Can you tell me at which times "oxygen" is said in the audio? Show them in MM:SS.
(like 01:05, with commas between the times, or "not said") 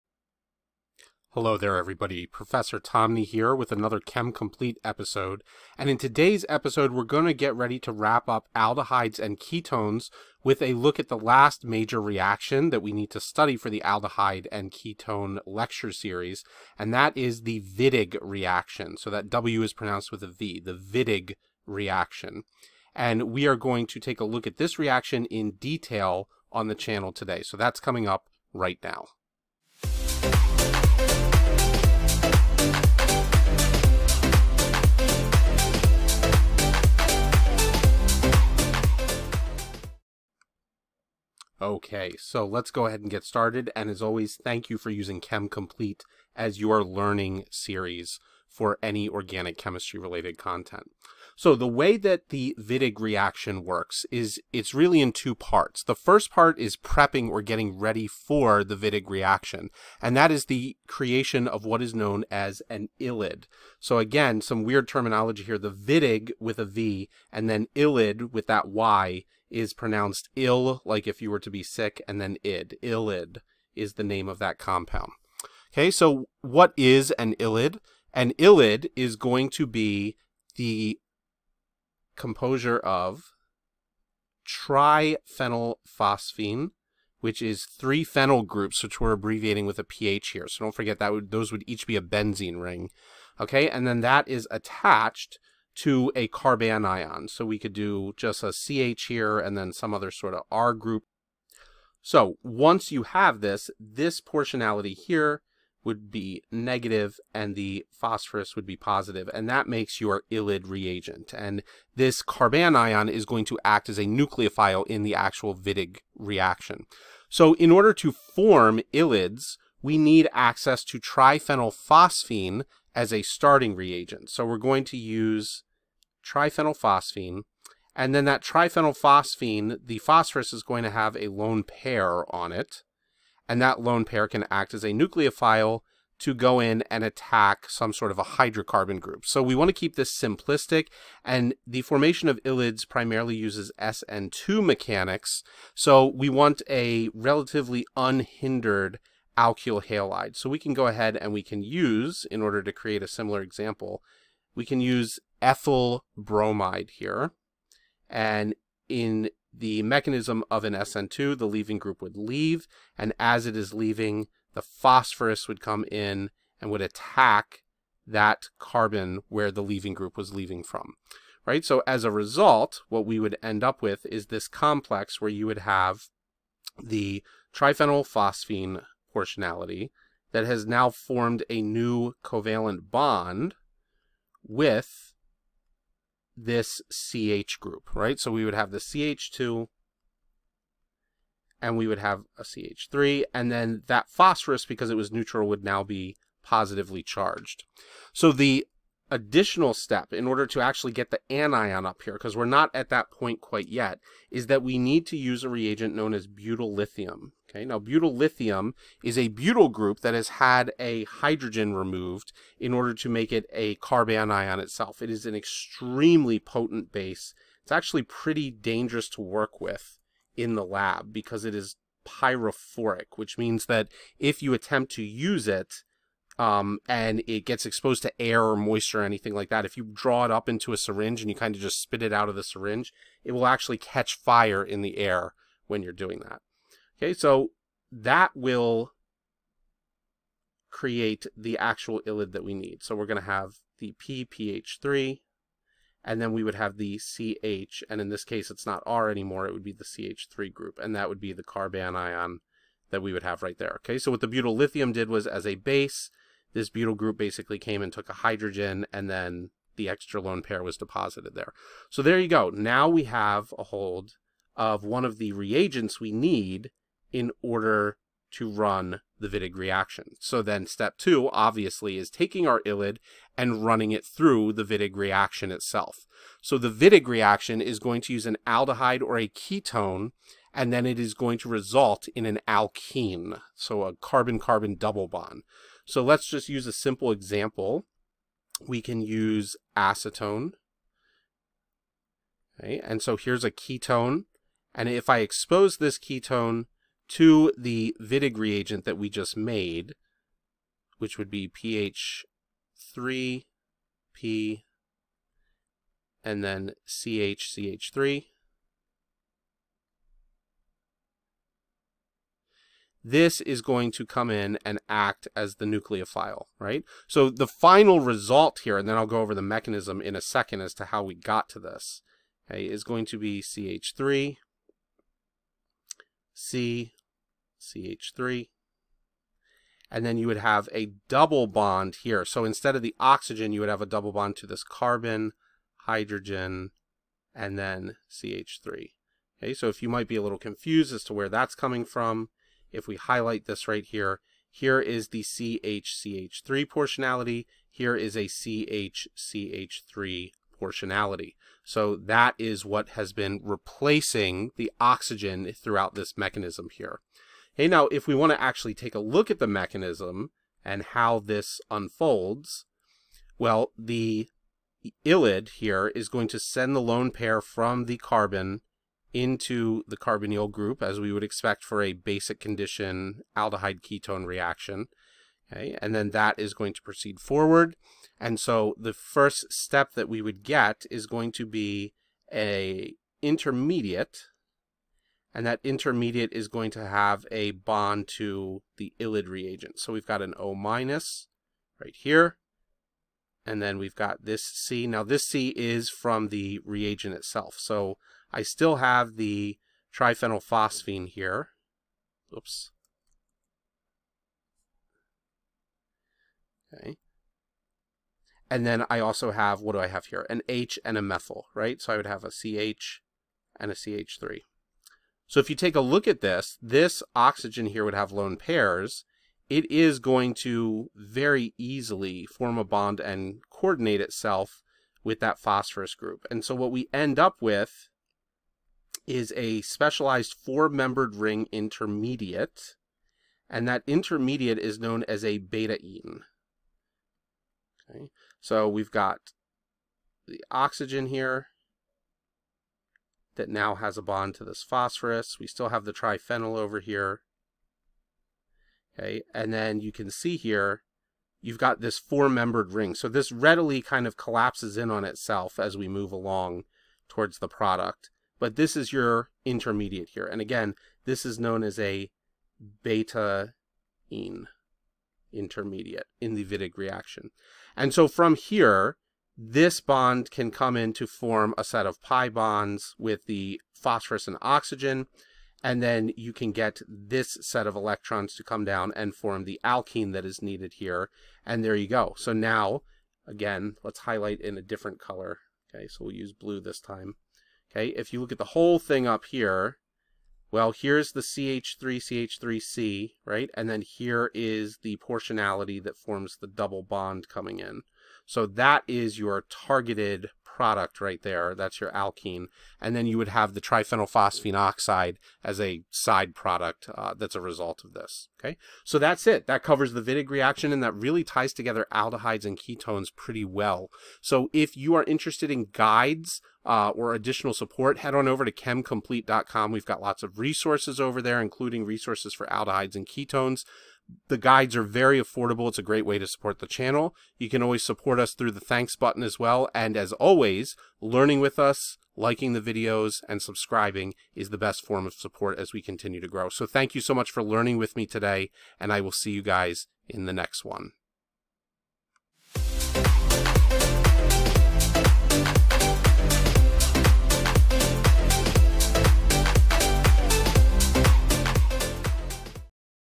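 05:32, 05:54, 06:57, 07:20, 07:54.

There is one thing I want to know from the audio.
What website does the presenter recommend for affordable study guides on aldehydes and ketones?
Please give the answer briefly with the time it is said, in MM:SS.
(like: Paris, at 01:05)
chemcomplete.com, at 08:38.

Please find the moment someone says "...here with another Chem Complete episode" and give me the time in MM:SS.
00:03.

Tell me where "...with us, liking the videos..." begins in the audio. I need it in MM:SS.
08:51.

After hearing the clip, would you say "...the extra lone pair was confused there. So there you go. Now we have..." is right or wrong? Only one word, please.
wrong.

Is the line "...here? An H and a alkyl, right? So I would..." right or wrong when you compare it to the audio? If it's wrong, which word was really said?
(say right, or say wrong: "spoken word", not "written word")
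wrong: "methyl", not "alkyl".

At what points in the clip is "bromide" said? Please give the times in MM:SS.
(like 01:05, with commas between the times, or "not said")
02:36.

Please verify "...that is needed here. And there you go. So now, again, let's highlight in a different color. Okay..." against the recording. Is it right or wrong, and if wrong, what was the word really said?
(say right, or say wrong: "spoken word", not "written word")
right.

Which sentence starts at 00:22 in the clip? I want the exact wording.
And we are going to take a look at this reaction in detail on the channel today.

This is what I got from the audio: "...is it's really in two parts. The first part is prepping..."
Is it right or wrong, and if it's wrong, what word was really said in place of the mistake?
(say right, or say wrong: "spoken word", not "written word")
right.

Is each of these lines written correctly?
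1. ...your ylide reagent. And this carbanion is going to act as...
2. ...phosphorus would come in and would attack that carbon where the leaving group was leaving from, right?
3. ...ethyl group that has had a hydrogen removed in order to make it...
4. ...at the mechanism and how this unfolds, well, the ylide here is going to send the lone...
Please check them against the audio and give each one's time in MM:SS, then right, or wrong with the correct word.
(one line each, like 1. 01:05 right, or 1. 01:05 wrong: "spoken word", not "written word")
1. 01:49 right
2. 02:44 right
3. 03:29 wrong: "butyl", not "ethyl"
4. 05:59 right.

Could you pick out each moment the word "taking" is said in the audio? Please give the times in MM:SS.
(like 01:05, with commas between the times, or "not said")
04:32.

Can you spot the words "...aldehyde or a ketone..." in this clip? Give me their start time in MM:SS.
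04:38.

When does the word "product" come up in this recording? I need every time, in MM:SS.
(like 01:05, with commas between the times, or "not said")
07:37, 08:20, 08:26.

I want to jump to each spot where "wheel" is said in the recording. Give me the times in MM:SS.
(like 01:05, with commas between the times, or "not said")
not said.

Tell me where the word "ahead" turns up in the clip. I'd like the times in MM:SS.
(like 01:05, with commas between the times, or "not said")
00:42, 02:30.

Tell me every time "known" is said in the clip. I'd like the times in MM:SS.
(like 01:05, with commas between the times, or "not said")
01:01, 03:25, 07:14, 07:41.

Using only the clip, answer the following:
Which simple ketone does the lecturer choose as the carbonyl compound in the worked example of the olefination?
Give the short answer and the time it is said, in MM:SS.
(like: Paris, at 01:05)
acetone, at 04:49.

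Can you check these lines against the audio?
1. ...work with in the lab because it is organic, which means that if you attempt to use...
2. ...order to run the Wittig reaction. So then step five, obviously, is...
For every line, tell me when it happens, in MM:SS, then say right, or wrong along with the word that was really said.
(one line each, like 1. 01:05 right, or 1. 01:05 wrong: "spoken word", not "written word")
1. 03:39 wrong: "pyrophoric", not "organic"
2. 04:27 wrong: "two", not "five".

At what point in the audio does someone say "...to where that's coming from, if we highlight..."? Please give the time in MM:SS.
05:41.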